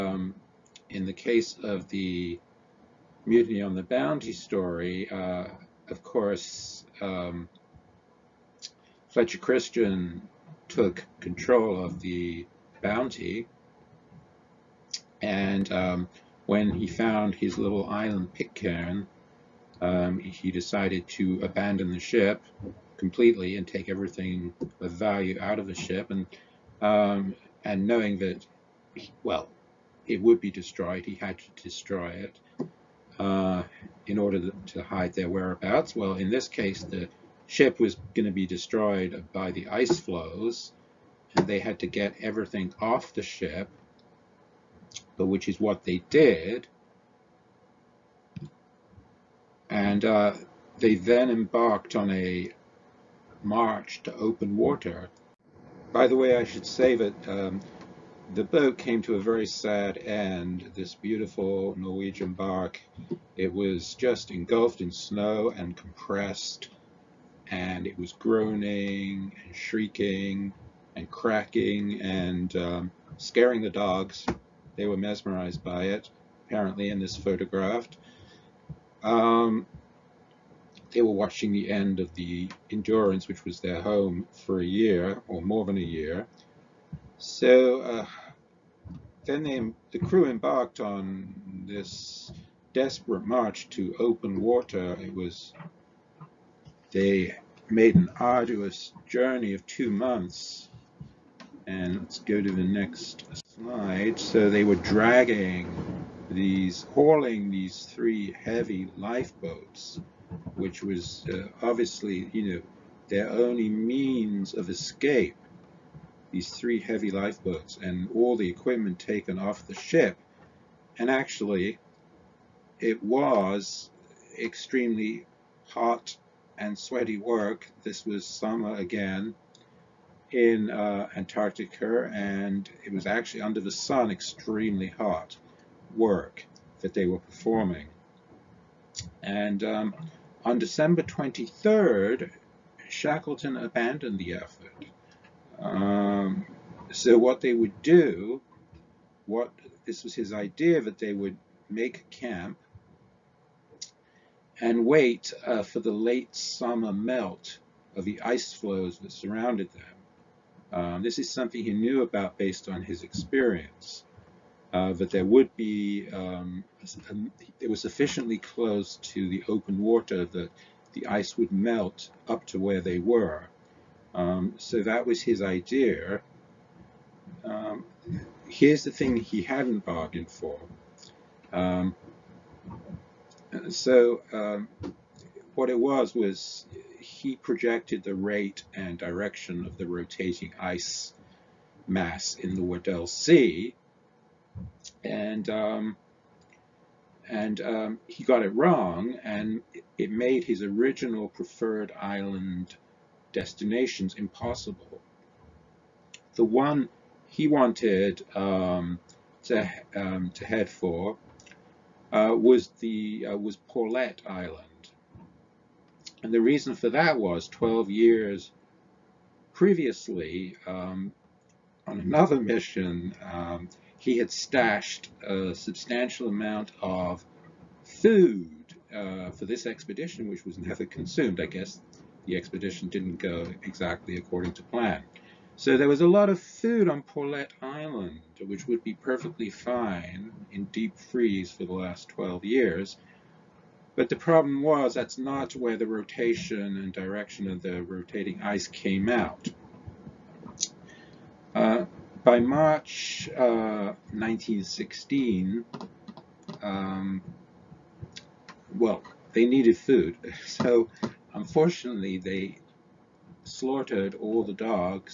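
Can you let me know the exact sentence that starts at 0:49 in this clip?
And uh, they then embarked on a march to open water.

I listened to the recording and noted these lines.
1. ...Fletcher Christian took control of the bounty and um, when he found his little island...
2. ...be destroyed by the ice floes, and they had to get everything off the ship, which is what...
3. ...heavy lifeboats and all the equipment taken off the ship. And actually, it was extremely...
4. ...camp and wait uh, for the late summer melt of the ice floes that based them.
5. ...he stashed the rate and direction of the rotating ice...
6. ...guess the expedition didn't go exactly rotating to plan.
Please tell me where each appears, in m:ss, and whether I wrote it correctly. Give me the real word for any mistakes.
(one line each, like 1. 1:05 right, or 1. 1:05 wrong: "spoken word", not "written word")
1. 0:09 right
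2. 0:38 right
3. 1:56 right
4. 2:32 wrong: "surrounded", not "based"
5. 3:06 wrong: "projected", not "stashed"
6. 3:51 wrong: "according", not "rotating".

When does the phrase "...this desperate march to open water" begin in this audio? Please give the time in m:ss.
1:31.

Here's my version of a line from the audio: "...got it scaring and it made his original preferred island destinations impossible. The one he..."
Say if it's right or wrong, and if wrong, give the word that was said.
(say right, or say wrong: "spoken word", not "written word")
wrong: "wrong", not "scaring".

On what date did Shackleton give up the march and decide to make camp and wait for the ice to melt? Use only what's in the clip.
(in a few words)
December 23rd.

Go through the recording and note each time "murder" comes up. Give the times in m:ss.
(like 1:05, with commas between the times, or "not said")
not said.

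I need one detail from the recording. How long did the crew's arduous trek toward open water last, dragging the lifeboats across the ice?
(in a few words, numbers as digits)
two months.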